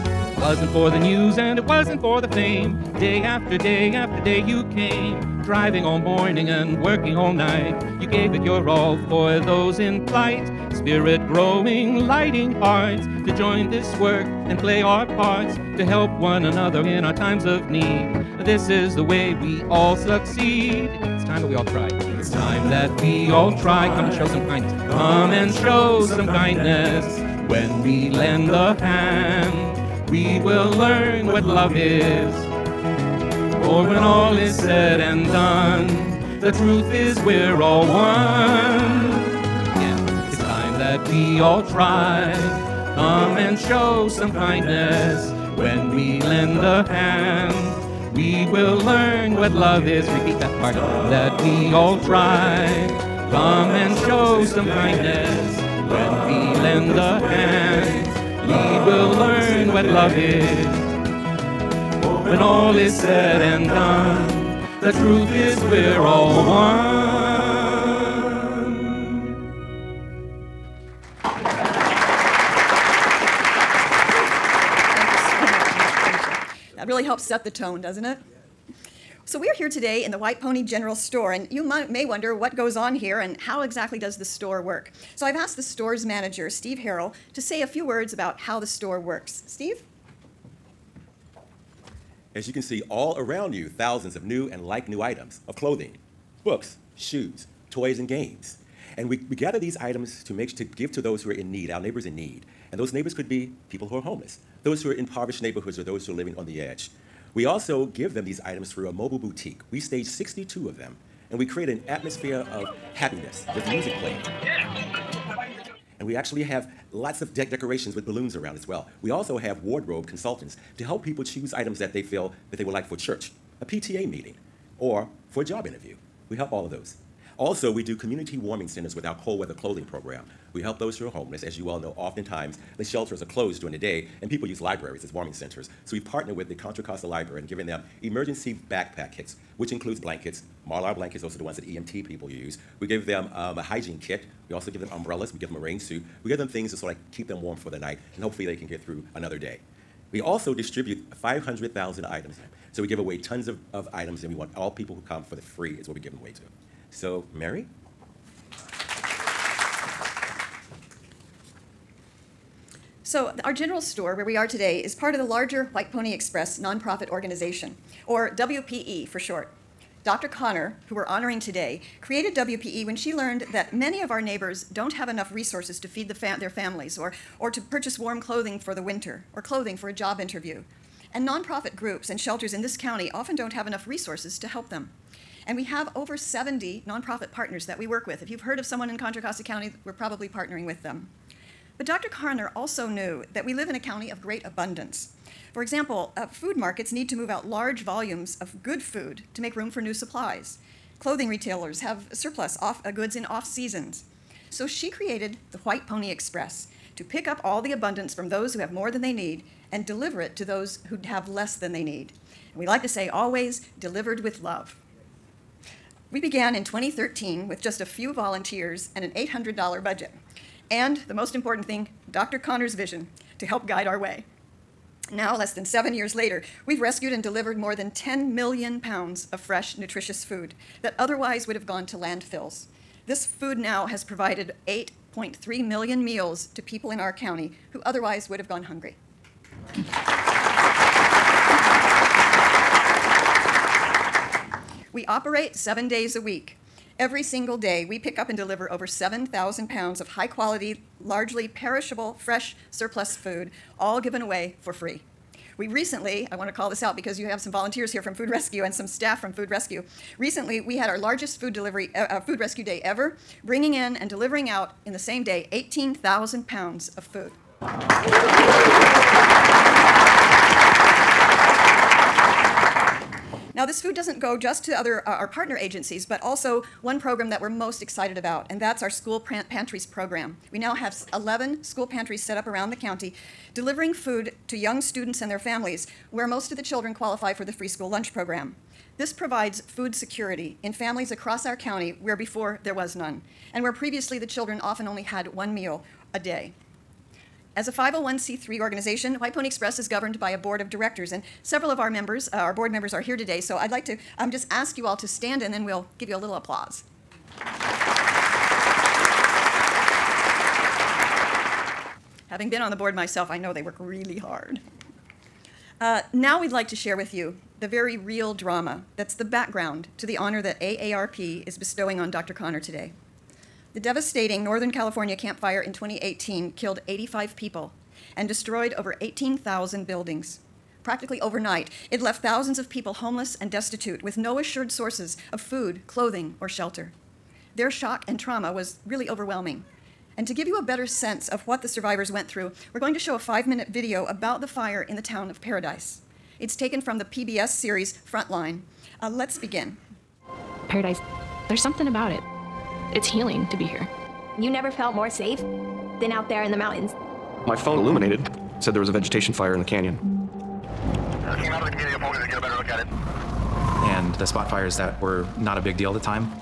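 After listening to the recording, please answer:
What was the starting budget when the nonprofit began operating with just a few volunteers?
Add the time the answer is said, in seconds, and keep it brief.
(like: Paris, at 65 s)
$800, at 219 s.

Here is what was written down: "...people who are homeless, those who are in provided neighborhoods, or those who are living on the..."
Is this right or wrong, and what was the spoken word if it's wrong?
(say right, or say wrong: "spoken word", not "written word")
wrong: "impoverished", not "provided".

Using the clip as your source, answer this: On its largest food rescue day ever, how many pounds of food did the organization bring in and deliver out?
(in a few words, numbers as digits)
18,000 pounds.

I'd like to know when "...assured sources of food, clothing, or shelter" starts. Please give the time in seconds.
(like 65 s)
334 s.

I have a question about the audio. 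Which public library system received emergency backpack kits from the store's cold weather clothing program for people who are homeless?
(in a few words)
Contra Costa Library.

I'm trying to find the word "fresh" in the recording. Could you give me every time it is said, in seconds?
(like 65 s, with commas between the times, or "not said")
229 s, 252 s.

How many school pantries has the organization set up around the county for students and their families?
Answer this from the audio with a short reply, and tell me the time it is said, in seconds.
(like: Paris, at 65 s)
11, at 281 s.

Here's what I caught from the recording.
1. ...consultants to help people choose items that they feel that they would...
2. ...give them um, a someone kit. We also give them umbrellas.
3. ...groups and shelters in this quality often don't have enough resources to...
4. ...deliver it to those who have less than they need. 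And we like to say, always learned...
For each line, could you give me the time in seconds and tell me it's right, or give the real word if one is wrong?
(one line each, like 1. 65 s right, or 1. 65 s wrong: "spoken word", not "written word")
1. 120 s right
2. 142 s wrong: "hygiene", not "someone"
3. 181 s wrong: "county", not "quality"
4. 209 s wrong: "delivered", not "learned".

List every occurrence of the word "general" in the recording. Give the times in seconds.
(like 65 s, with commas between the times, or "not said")
80 s, 163 s.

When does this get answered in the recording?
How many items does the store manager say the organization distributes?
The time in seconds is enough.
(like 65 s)
151 s.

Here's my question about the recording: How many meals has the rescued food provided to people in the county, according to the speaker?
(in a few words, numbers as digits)
8.3 million.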